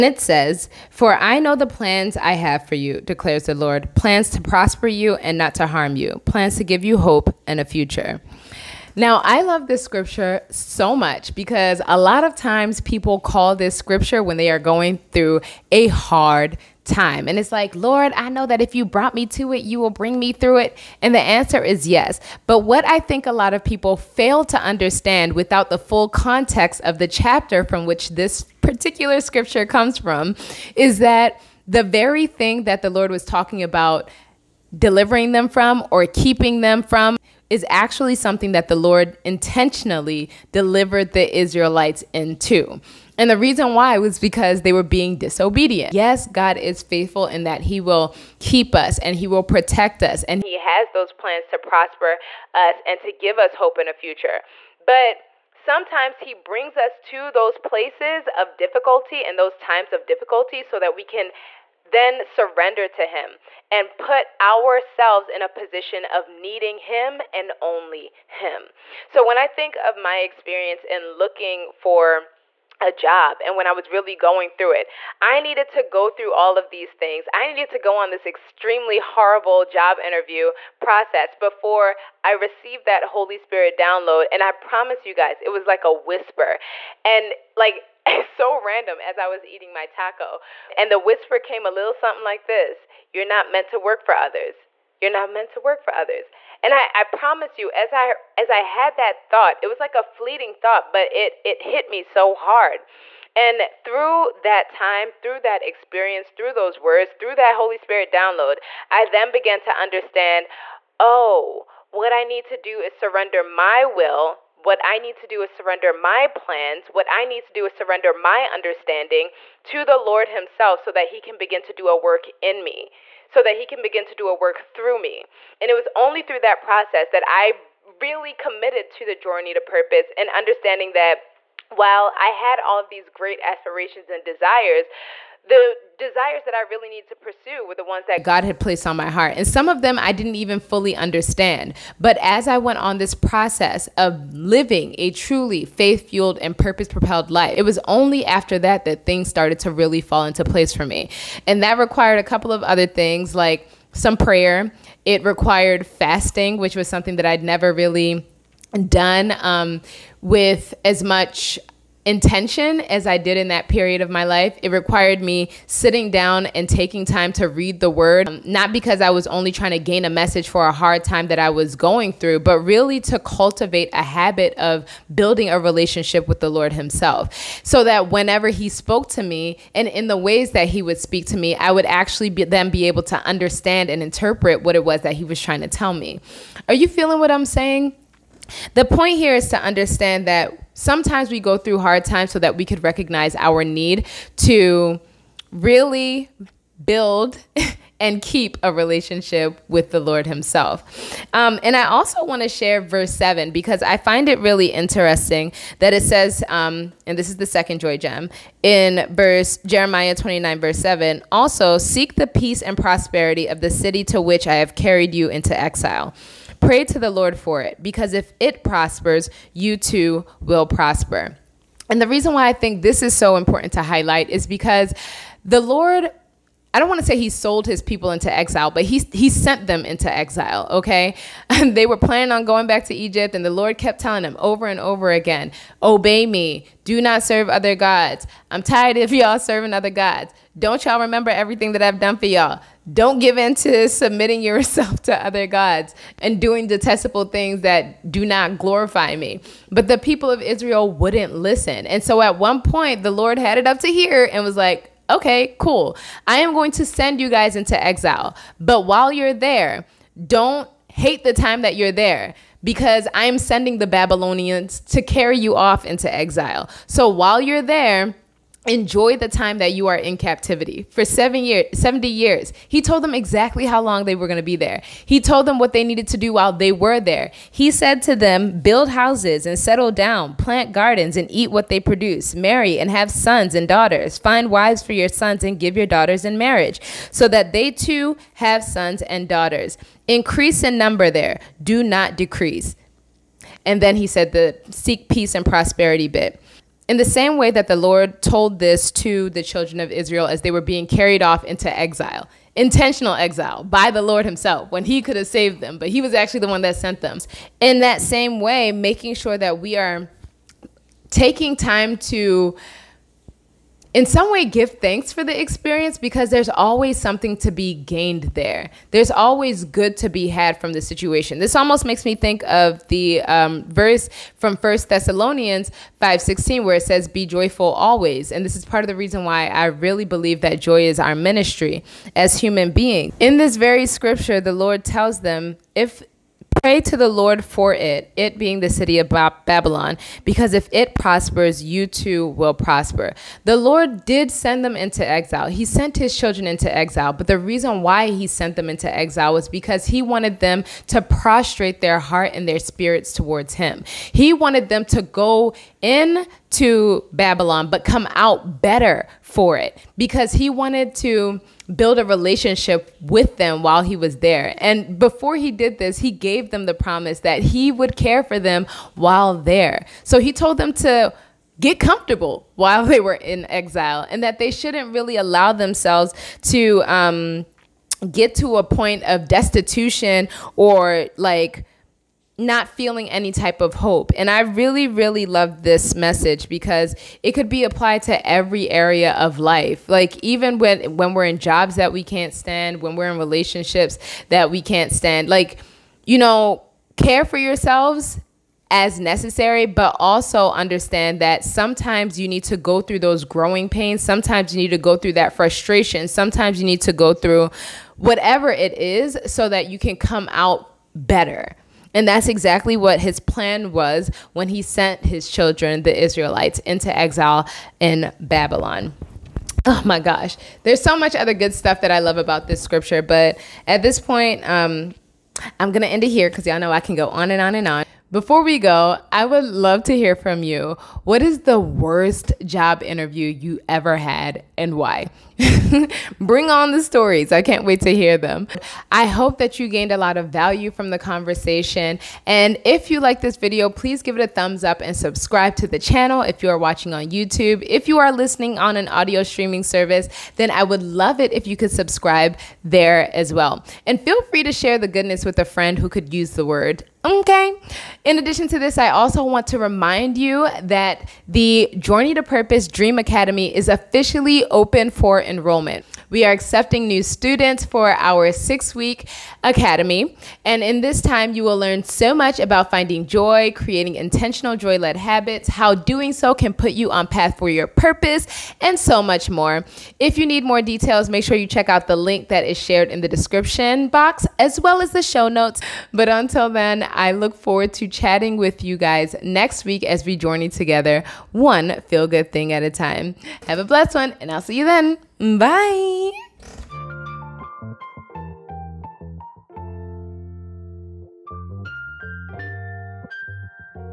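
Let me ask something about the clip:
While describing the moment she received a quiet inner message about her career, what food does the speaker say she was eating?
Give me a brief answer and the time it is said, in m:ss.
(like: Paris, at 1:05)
taco, at 1:29.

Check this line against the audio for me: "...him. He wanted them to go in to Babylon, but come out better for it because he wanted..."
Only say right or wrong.
right.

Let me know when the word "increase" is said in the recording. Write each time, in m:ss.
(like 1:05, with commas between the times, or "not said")
4:50.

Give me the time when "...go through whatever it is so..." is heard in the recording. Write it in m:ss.
6:46.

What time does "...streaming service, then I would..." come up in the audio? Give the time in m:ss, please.
7:29.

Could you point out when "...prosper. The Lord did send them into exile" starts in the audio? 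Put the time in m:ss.
5:42.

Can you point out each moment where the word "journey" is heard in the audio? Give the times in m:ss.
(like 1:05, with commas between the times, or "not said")
2:09, 8:10.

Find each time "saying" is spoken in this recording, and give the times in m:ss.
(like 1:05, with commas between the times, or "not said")
3:07.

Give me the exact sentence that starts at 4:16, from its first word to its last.
I am going to send you guys into exile.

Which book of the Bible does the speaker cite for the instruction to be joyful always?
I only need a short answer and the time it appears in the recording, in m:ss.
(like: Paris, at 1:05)
First Thessalonians, at 5:24.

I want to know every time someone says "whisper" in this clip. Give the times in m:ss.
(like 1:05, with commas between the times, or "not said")
1:25, 1:30.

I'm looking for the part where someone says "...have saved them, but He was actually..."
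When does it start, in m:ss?
5:05.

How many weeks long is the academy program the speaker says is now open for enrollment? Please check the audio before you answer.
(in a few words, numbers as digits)
6.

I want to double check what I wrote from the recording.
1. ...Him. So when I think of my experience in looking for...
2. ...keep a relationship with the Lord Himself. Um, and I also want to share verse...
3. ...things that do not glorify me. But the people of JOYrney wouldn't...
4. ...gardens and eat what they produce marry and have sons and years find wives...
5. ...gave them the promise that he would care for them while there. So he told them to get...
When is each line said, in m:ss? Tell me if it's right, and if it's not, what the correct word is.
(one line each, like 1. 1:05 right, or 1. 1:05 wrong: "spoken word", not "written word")
1. 1:08 right
2. 3:18 right
3. 4:07 wrong: "Israel", not "JOYrney"
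4. 4:40 wrong: "daughters", not "years"
5. 6:06 right.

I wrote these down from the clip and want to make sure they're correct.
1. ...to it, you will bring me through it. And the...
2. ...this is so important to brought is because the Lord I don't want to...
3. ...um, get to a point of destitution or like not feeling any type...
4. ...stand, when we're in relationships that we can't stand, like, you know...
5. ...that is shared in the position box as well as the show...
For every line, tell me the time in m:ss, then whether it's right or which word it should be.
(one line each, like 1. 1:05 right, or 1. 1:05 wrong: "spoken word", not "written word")
1. 0:19 right
2. 3:42 wrong: "highlight", not "brought"
3. 6:16 right
4. 6:32 right
5. 8:02 wrong: "description", not "position".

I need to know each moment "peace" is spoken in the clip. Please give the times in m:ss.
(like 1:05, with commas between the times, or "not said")
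3:32, 4:55.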